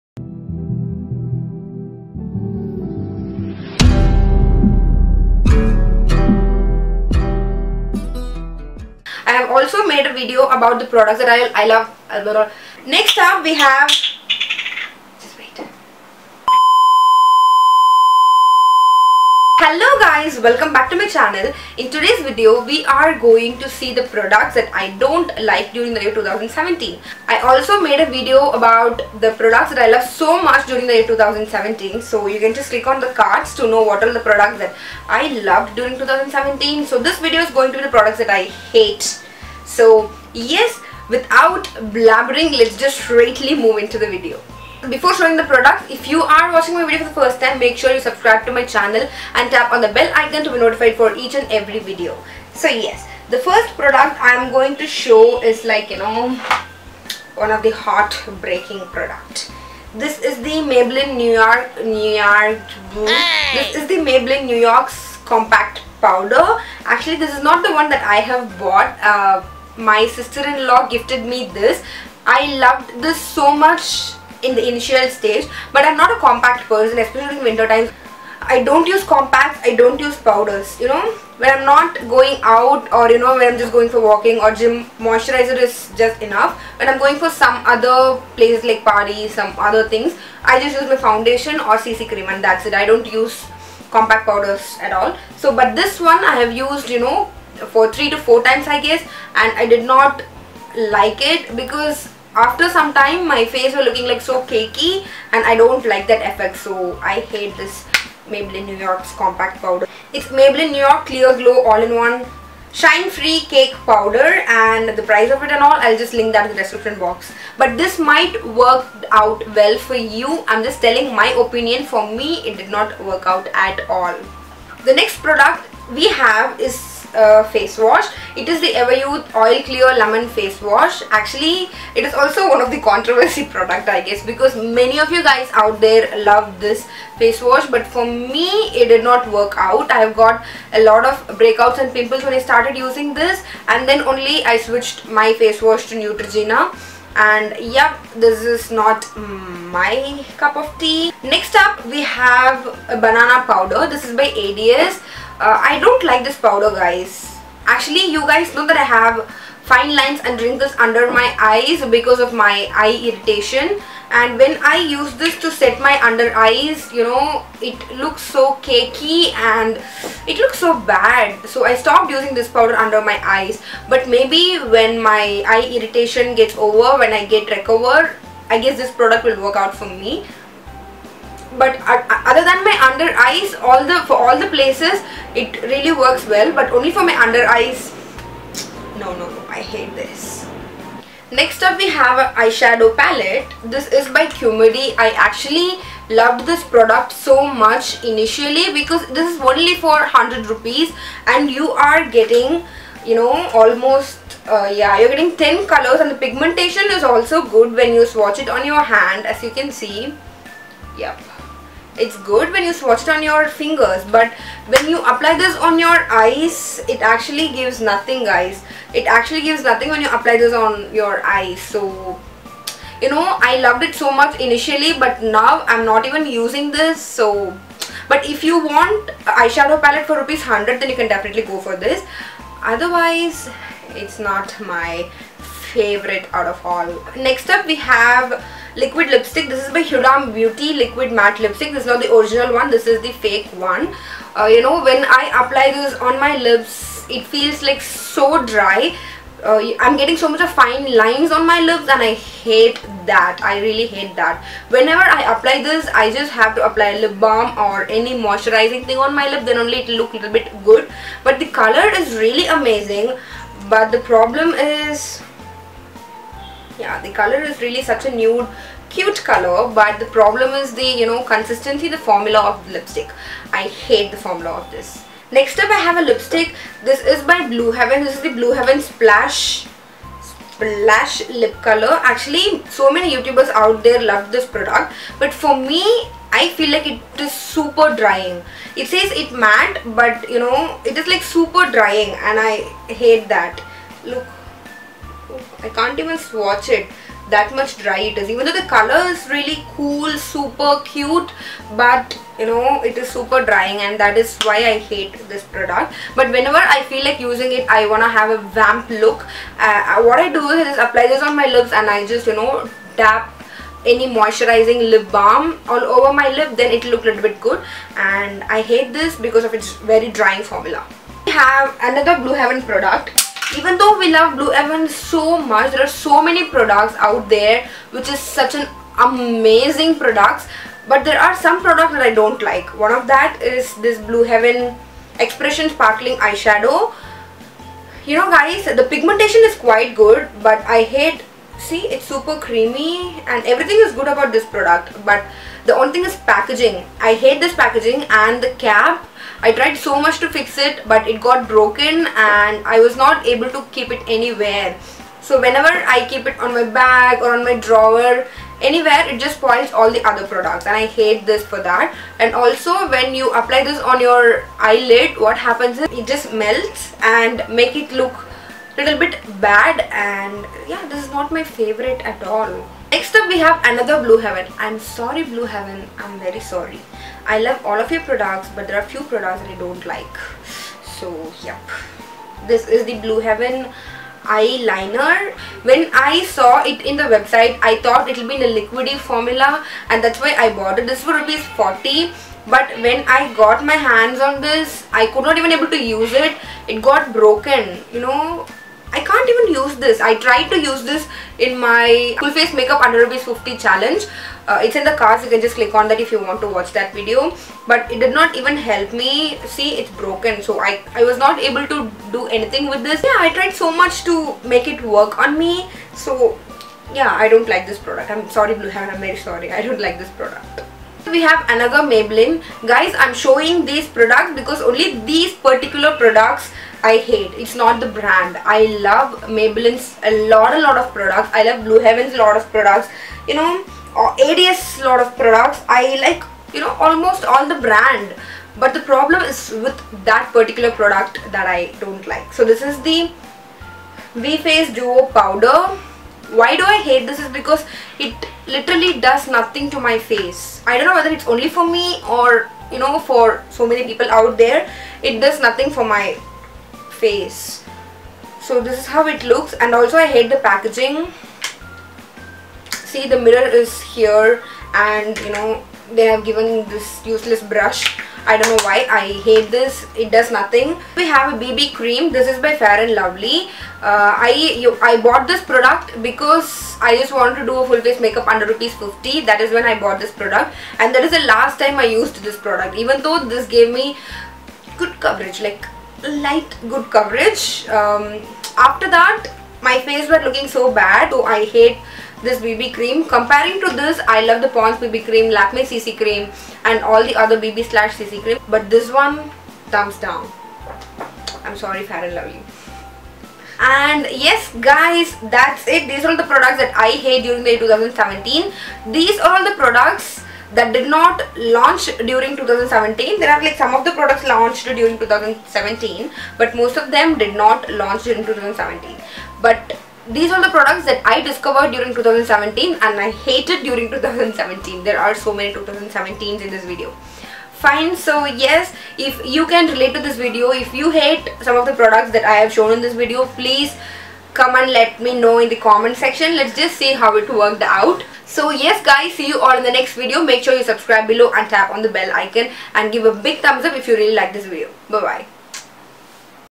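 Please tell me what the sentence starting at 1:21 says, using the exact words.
When I'm not going out or, you know, when I'm just going for walking or gym, moisturizer is just enough.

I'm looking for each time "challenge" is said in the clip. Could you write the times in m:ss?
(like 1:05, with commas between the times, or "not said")
6:43.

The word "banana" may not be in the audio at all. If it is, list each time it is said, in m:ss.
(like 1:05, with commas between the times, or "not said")
2:32.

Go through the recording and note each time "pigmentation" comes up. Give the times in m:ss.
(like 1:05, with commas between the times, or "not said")
3:26, 5:38.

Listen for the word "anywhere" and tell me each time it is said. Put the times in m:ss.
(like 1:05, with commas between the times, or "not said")
5:54, 5:58.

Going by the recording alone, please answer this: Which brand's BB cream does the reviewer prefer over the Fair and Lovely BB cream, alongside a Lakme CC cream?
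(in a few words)
Pond's.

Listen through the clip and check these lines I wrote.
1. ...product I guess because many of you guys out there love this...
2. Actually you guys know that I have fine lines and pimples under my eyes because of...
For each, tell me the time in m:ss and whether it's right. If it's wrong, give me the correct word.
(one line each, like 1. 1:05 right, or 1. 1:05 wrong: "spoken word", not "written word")
1. 2:13 right
2. 2:37 wrong: "wrinkles", not "pimples".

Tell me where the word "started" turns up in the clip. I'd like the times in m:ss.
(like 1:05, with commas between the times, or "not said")
2:22.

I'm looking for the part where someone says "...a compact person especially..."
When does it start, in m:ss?
1:16.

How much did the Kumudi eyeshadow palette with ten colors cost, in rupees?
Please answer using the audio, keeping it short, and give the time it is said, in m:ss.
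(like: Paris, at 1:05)
100, at 3:20.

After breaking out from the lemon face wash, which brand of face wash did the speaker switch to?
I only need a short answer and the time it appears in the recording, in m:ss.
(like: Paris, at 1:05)
Neutrogena, at 2:25.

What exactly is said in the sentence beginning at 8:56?
Let's just see how it worked out.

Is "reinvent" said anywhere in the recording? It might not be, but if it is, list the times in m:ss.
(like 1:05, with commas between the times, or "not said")
not said.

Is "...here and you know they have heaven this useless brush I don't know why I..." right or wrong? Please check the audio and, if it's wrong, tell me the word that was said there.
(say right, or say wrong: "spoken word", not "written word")
wrong: "given", not "heaven".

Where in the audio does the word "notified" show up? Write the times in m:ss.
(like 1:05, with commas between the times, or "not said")
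0:50.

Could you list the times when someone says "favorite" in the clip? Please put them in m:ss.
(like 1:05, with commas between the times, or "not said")
3:55, 6:11.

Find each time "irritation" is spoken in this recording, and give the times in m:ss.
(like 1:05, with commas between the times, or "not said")
2:43, 2:55.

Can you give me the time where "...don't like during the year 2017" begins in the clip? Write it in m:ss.
0:24.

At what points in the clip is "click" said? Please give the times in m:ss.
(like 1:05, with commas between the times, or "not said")
0:32, 6:45.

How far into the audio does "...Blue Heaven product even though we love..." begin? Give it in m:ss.
5:22.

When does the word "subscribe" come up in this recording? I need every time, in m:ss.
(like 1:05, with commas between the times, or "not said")
0:47, 9:00.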